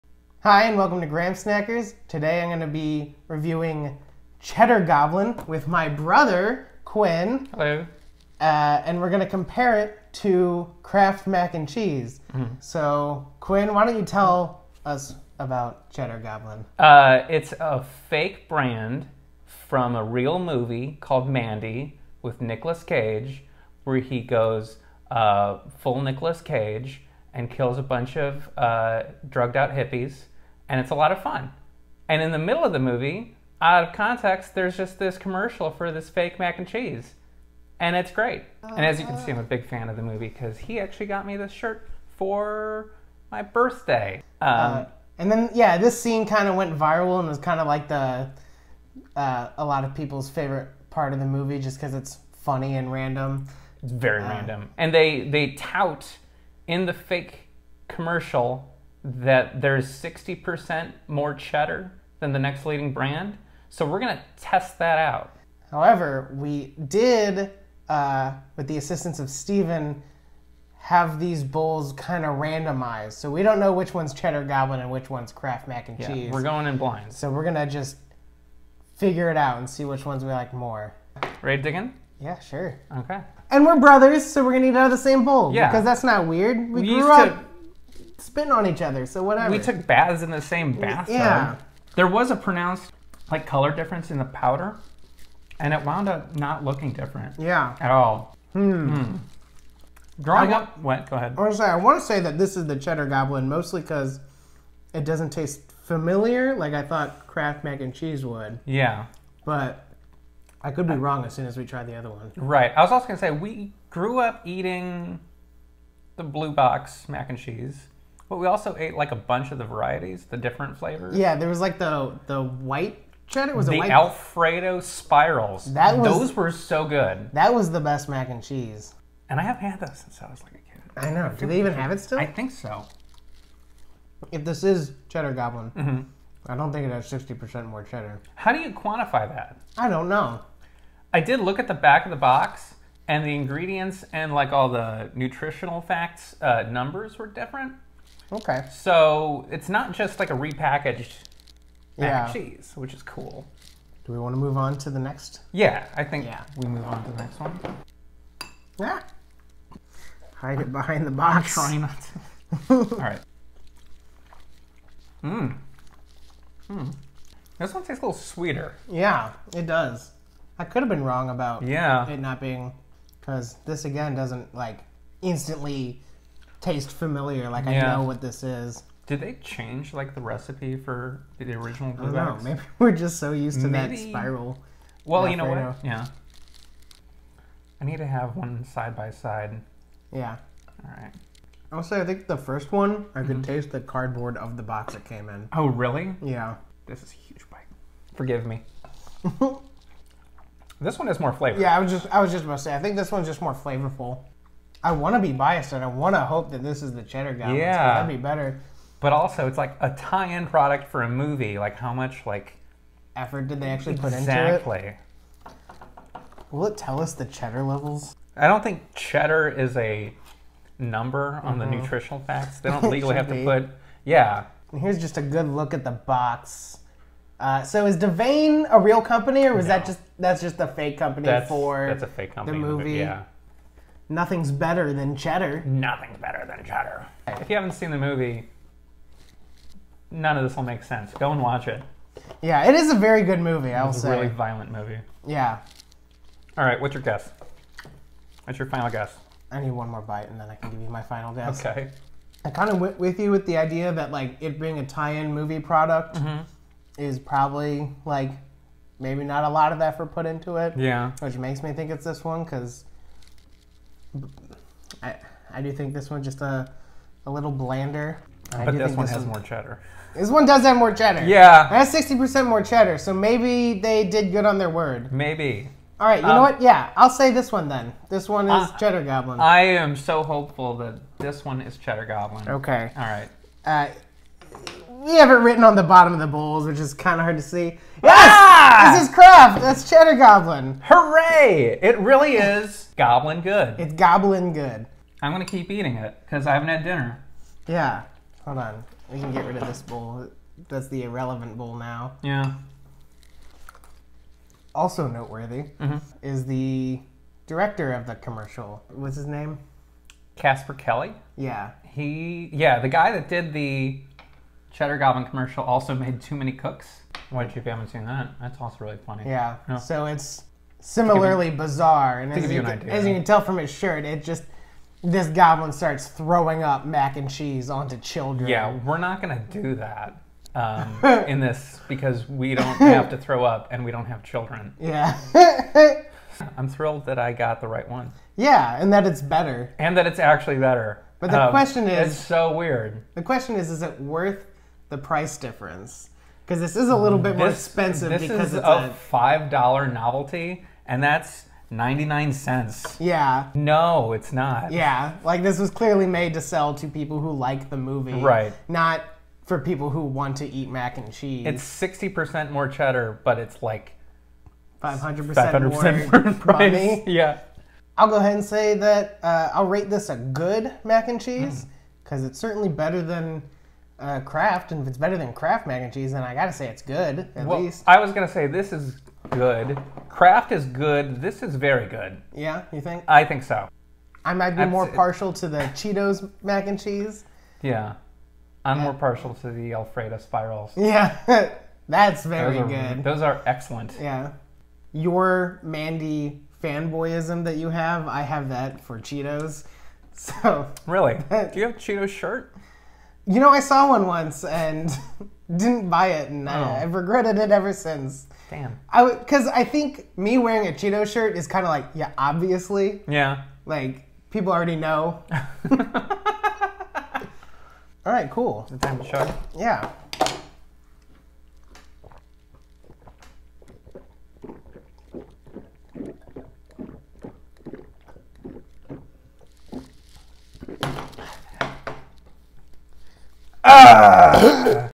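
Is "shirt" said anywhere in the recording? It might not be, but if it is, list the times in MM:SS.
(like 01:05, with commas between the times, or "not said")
00:41, 05:23, 06:42, 06:51.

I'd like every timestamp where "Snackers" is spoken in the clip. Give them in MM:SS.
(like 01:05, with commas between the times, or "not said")
00:01.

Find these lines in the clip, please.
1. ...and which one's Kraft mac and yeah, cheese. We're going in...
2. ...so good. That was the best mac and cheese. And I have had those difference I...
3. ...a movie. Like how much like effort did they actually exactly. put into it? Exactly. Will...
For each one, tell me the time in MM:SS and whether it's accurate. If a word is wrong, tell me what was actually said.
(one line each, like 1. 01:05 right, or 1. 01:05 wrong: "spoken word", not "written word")
1. 01:14 right
2. 02:06 wrong: "since", not "difference"
3. 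03:31 right.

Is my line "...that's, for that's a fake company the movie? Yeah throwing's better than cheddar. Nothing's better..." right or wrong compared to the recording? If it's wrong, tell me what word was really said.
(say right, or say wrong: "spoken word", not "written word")
wrong: "nothing", not "throwing".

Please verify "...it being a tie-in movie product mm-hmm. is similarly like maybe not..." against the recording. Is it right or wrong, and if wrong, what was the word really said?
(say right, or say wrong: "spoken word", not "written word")
wrong: "probably", not "similarly".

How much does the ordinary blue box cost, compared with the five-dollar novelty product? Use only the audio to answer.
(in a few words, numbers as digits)
99 cents.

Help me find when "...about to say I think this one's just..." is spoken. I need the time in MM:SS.
03:22.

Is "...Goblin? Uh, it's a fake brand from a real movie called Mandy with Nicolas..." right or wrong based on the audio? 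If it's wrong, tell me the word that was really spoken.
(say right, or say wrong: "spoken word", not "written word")
right.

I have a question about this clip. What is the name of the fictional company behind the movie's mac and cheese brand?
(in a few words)
Devane.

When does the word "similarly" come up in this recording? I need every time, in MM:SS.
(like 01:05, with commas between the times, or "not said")
05:20.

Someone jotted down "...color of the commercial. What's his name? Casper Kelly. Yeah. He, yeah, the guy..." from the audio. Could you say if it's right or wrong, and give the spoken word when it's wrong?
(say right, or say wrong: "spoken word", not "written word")
wrong: "director", not "color".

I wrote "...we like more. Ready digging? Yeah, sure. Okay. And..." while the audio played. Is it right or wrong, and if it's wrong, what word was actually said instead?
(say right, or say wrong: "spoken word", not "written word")
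right.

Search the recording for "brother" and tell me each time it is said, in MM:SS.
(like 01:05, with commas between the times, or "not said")
00:05, 01:23.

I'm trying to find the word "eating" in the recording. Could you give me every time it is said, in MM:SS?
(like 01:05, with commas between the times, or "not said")
01:54, 04:55.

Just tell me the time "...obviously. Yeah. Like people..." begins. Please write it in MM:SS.
06:52.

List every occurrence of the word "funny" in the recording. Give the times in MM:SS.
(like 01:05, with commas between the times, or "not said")
00:52, 05:19.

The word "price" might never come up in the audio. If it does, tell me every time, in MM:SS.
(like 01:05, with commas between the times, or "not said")
05:44, 06:06.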